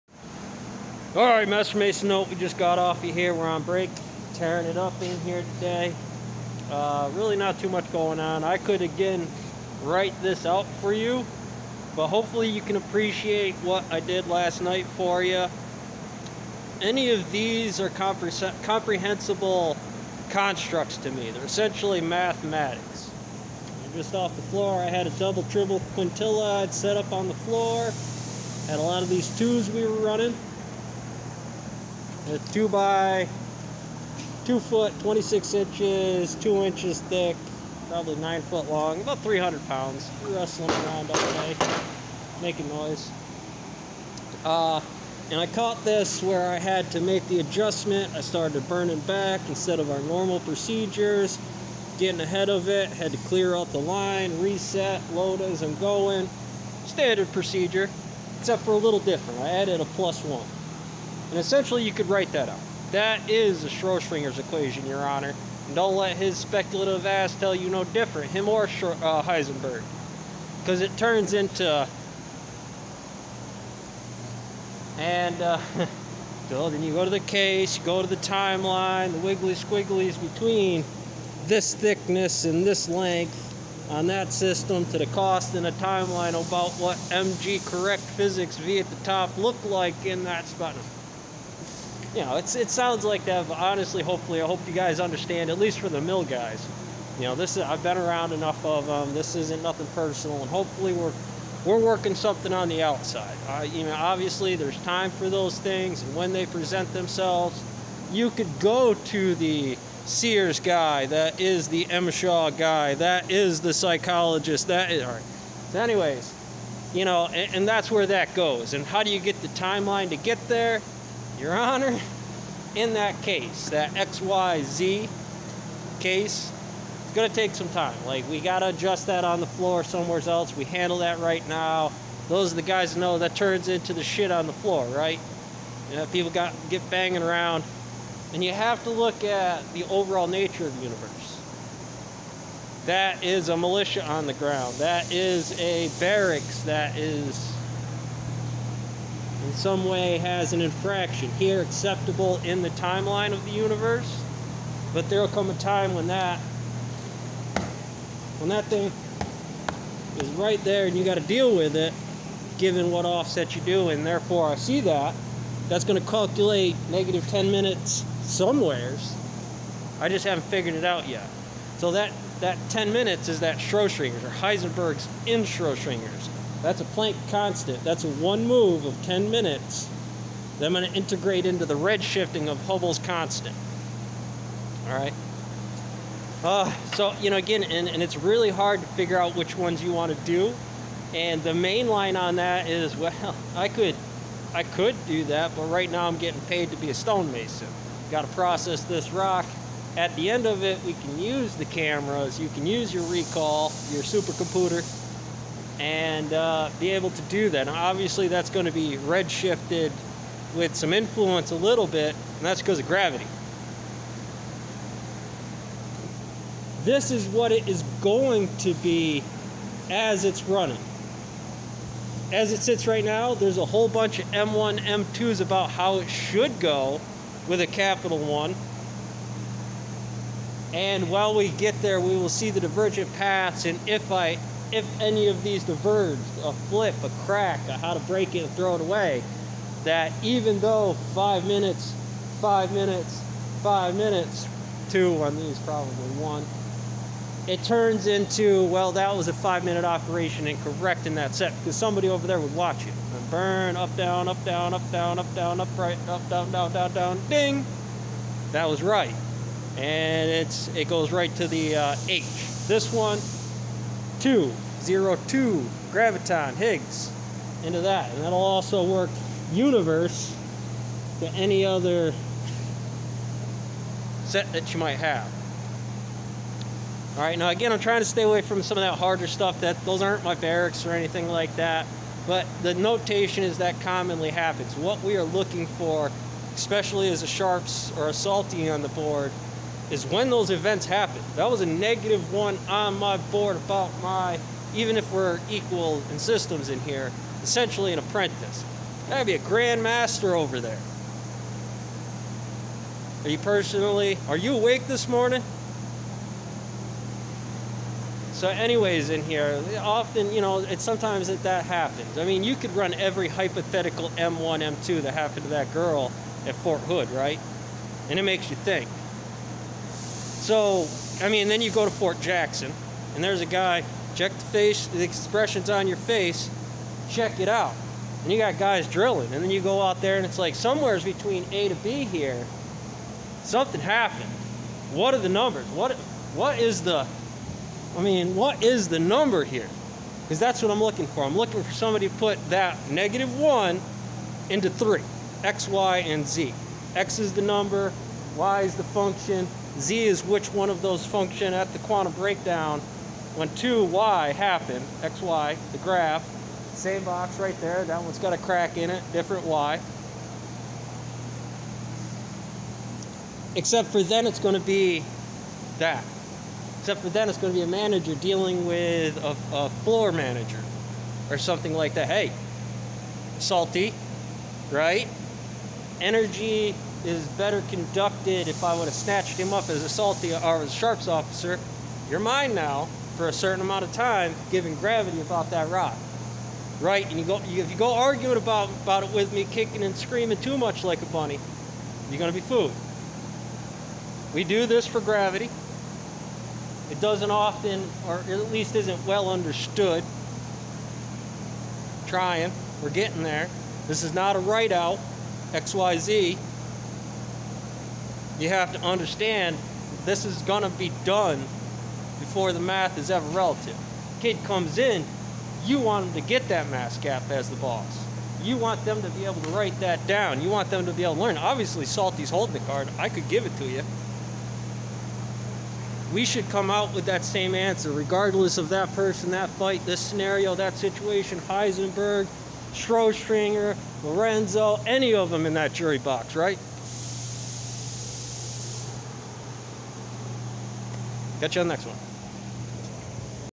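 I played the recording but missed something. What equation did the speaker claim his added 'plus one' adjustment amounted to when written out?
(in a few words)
Schrodinger's equation.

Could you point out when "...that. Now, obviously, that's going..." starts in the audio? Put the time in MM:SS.
03:27.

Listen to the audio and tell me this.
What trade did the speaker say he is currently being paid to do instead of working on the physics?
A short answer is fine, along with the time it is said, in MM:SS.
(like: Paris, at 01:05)
stonemason, at 03:16.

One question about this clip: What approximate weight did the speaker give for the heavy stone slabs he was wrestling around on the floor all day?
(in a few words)
300 pounds.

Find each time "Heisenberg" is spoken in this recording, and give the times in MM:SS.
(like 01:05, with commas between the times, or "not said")
01:09, 02:54, 07:11.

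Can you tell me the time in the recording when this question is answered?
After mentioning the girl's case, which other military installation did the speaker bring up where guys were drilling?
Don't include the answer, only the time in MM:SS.
05:21.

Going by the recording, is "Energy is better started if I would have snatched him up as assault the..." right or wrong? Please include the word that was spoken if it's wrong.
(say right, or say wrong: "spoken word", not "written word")
wrong: "conducted", not "started".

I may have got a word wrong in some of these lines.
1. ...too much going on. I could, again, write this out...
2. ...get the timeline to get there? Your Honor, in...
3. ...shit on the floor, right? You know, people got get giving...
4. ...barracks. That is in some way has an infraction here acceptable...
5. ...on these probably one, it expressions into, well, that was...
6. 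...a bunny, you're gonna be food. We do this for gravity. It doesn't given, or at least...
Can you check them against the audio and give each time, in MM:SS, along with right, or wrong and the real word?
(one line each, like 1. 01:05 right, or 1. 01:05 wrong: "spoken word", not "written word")
1. 00:07 right
2. 01:59 right
3. 02:14 wrong: "banging", not "giving"
4. 02:25 right
5. 04:05 wrong: "turns", not "expressions"
6. 06:31 wrong: "often", not "given".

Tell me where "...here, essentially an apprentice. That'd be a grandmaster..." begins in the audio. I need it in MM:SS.
04:56.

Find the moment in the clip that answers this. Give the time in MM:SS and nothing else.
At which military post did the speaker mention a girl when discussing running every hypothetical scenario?
05:16.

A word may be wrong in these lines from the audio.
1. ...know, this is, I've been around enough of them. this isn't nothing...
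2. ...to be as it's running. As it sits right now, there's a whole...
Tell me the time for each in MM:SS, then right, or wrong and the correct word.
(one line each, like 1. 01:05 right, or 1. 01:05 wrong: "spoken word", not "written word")
1. 01:37 right
2. 03:38 right.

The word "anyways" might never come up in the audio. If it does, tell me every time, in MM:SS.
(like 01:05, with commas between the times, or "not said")
01:55, 05:08.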